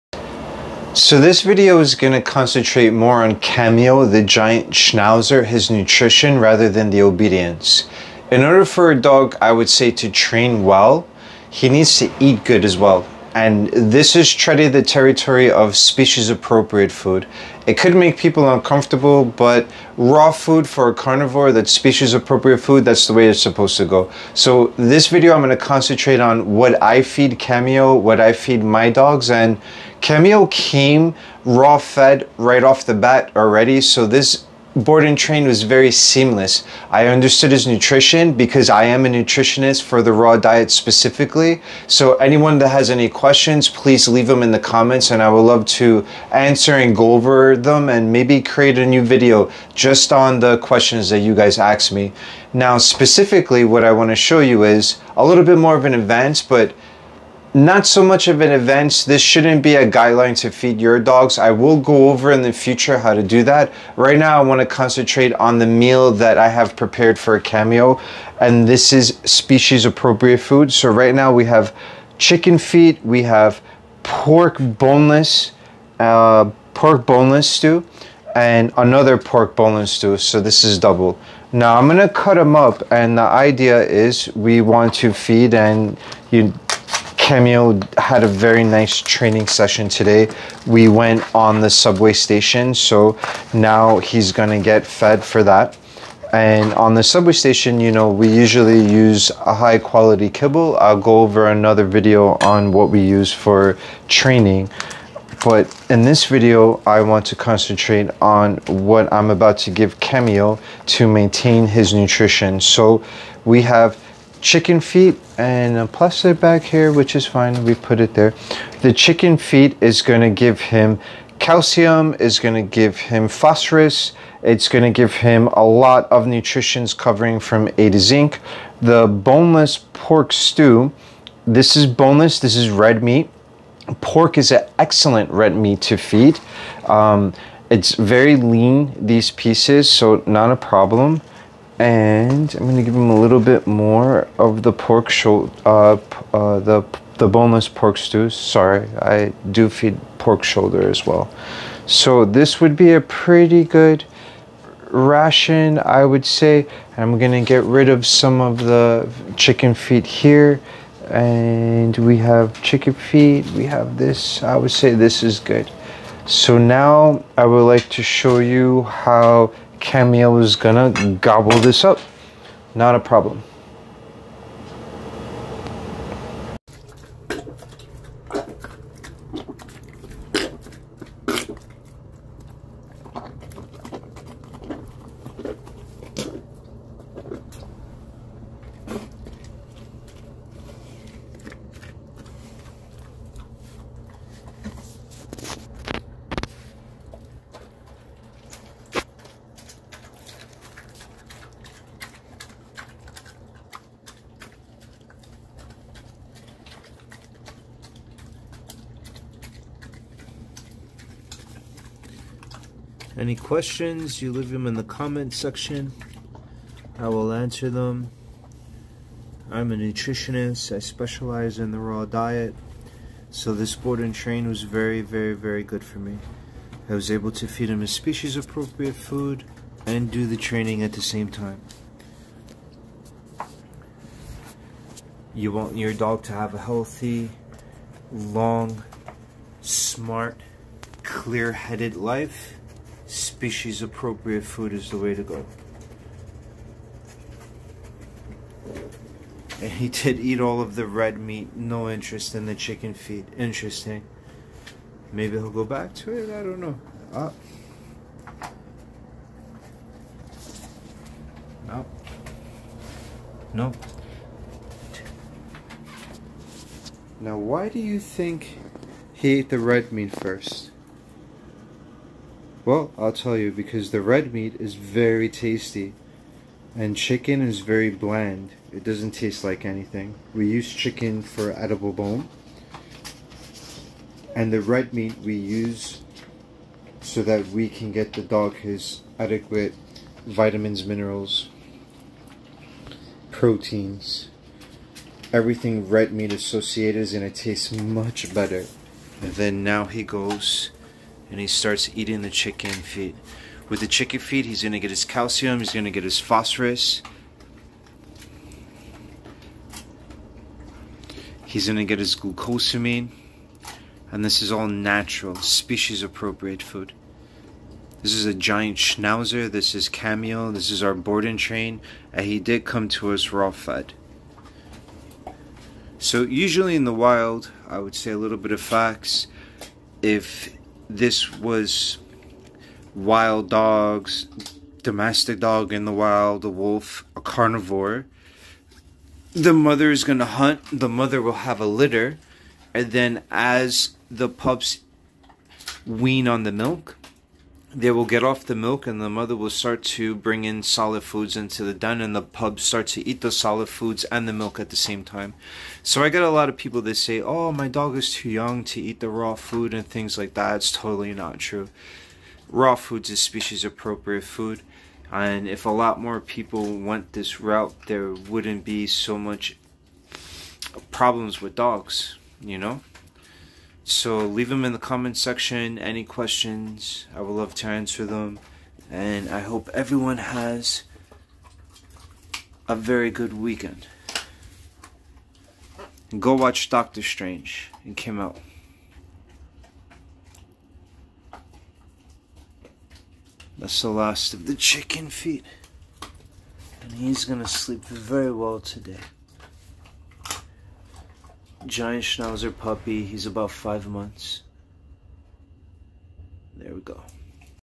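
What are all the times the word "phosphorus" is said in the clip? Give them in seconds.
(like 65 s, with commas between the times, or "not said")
123 s, 306 s.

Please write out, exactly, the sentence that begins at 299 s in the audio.
And then now he goes and he starts eating the chicken feet.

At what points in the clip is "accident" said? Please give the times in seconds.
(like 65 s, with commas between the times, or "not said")
not said.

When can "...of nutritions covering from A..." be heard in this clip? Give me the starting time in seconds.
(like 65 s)
126 s.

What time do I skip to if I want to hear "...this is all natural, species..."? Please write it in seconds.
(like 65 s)
314 s.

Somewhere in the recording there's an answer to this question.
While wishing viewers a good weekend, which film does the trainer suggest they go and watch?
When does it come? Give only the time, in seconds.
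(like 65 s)
386 s.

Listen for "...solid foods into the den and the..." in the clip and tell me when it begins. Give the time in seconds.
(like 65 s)
350 s.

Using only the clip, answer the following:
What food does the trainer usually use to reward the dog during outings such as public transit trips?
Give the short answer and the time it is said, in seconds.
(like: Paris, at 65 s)
high quality kibble, at 99 s.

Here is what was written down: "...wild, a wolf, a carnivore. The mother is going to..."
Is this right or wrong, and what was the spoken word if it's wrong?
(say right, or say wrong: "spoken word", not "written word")
right.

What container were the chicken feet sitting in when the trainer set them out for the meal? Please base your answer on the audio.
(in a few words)
a plastic bag.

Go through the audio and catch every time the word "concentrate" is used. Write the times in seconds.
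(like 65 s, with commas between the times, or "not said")
2 s, 25 s, 64 s, 107 s.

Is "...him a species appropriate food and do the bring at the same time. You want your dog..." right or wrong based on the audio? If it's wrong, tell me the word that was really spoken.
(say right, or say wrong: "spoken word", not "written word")
wrong: "training", not "bring".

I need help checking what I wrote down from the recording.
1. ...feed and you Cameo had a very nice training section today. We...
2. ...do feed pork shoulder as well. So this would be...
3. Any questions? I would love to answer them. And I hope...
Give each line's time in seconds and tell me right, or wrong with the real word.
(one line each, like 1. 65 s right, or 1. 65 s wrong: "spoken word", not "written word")
1. 85 s wrong: "session", not "section"
2. 149 s right
3. 375 s right.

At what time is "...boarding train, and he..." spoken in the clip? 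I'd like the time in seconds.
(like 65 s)
320 s.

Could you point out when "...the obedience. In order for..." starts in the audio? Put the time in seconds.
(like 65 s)
6 s.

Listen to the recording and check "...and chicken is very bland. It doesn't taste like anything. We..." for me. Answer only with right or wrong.
right.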